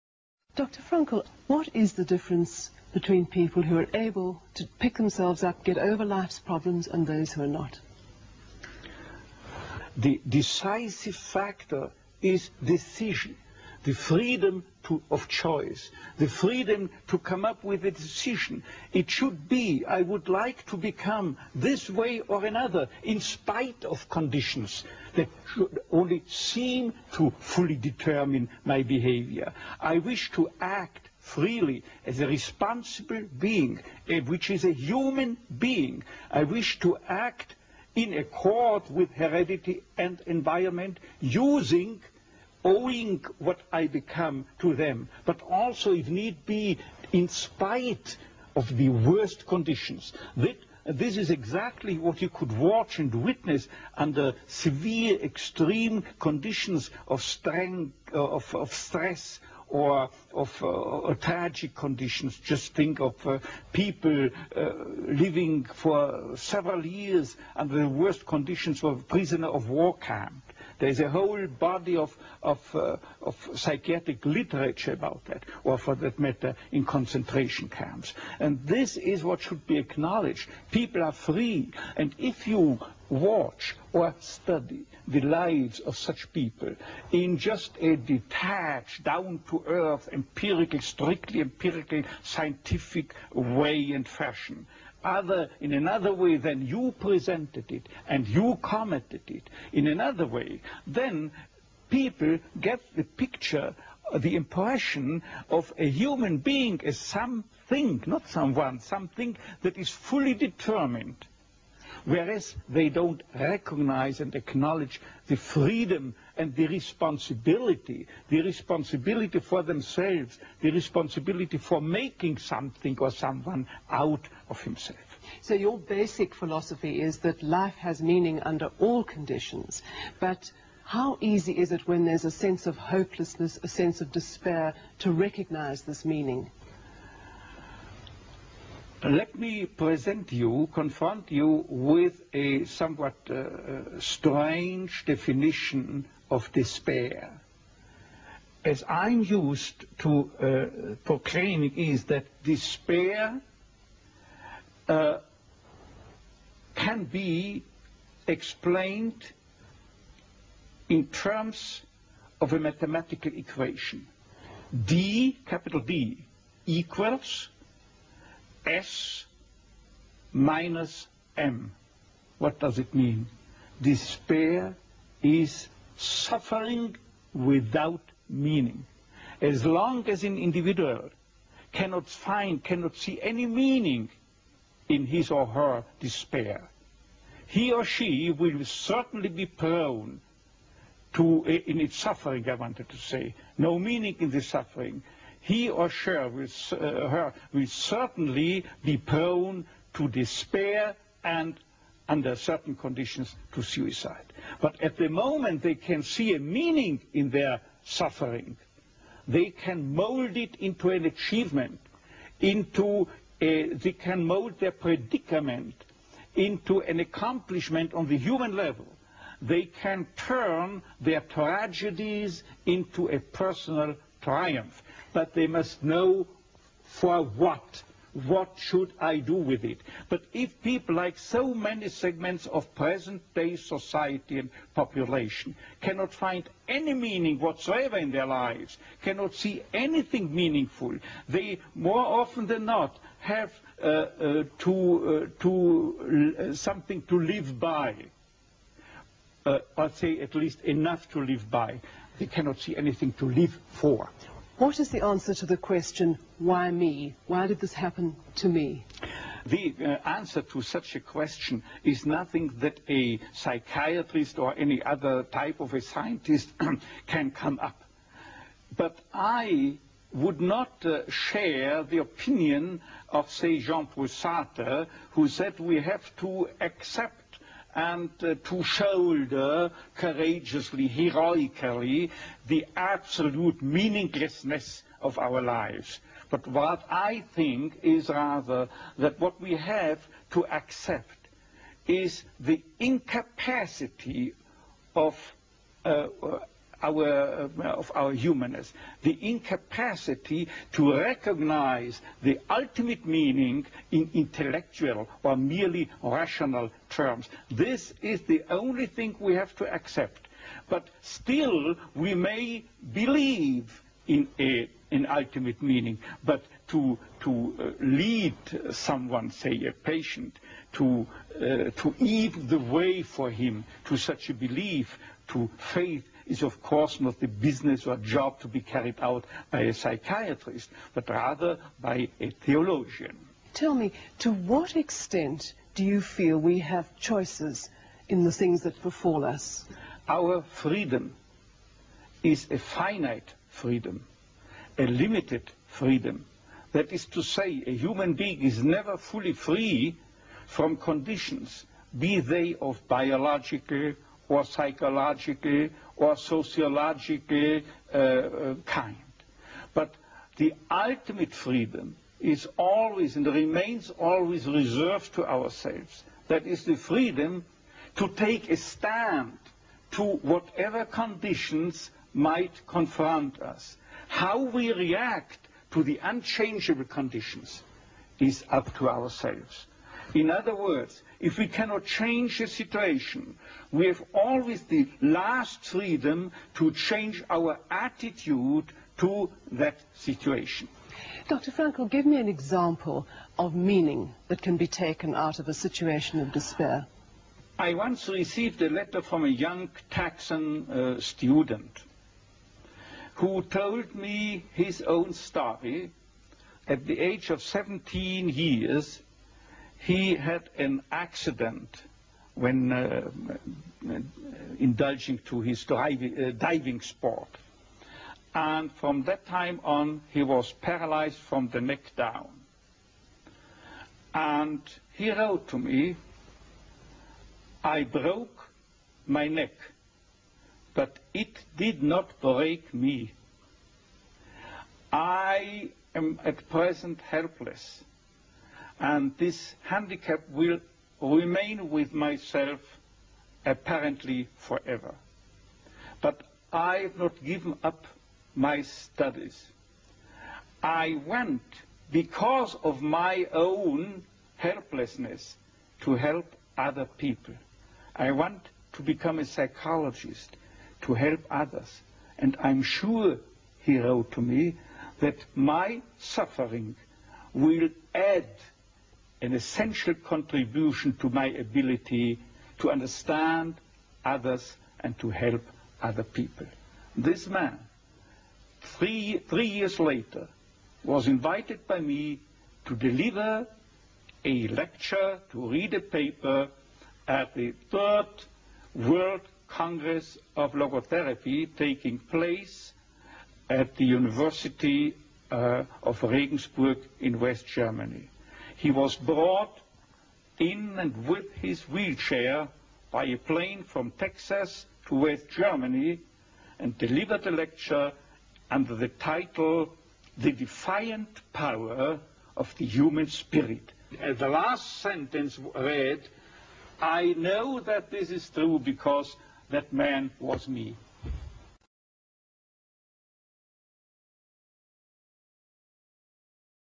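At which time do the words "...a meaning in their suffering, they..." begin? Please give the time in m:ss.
3:26.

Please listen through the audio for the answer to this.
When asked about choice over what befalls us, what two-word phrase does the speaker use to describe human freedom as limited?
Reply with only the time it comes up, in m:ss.
5:42.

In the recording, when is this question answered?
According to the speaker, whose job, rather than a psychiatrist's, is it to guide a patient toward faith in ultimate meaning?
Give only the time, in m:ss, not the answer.
5:32.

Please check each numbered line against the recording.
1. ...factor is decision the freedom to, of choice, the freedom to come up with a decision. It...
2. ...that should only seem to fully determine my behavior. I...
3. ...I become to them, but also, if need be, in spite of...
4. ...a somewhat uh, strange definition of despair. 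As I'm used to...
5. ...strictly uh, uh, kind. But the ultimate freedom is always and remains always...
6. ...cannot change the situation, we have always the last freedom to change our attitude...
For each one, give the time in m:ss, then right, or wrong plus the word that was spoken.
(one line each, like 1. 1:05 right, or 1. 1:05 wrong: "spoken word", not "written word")
1. 0:11 right
2. 0:25 right
3. 0:43 right
4. 2:22 right
5. 5:56 wrong: "sociologically", not "strictly"
6. 6:21 right.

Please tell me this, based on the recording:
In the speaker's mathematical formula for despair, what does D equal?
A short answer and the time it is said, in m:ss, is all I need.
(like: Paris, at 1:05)
S minus M, at 2:48.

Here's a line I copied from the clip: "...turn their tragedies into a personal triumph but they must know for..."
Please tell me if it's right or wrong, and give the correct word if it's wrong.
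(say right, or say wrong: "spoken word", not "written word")
right.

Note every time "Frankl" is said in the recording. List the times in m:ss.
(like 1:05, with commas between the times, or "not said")
0:00, 6:31.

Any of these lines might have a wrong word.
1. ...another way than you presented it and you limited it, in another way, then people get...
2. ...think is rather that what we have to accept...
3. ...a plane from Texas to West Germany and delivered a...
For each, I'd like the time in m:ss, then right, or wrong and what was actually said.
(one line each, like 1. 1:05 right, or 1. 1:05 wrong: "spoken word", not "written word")
1. 1:35 wrong: "commented", not "limited"
2. 4:47 right
3. 8:23 right.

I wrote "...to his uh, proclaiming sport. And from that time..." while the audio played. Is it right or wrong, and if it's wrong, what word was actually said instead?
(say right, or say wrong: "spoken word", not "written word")
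wrong: "diving", not "proclaiming".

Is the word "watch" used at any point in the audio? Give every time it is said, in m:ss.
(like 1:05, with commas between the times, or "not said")
0:52, 1:23.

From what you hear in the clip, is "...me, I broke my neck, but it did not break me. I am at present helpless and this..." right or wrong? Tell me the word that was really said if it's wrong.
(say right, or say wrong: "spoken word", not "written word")
right.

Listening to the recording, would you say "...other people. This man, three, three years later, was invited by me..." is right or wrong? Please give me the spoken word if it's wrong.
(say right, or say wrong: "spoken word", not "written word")
right.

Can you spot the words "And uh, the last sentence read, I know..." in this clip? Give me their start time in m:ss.
8:33.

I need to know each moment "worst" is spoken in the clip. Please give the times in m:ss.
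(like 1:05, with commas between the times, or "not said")
0:48, 1:07.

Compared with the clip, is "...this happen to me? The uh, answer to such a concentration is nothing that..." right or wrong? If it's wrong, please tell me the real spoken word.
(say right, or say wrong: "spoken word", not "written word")
wrong: "question", not "concentration".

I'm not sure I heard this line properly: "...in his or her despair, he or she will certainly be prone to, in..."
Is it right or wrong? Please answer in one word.
right.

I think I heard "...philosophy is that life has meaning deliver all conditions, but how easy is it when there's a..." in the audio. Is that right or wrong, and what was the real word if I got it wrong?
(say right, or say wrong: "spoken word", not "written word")
wrong: "under", not "deliver".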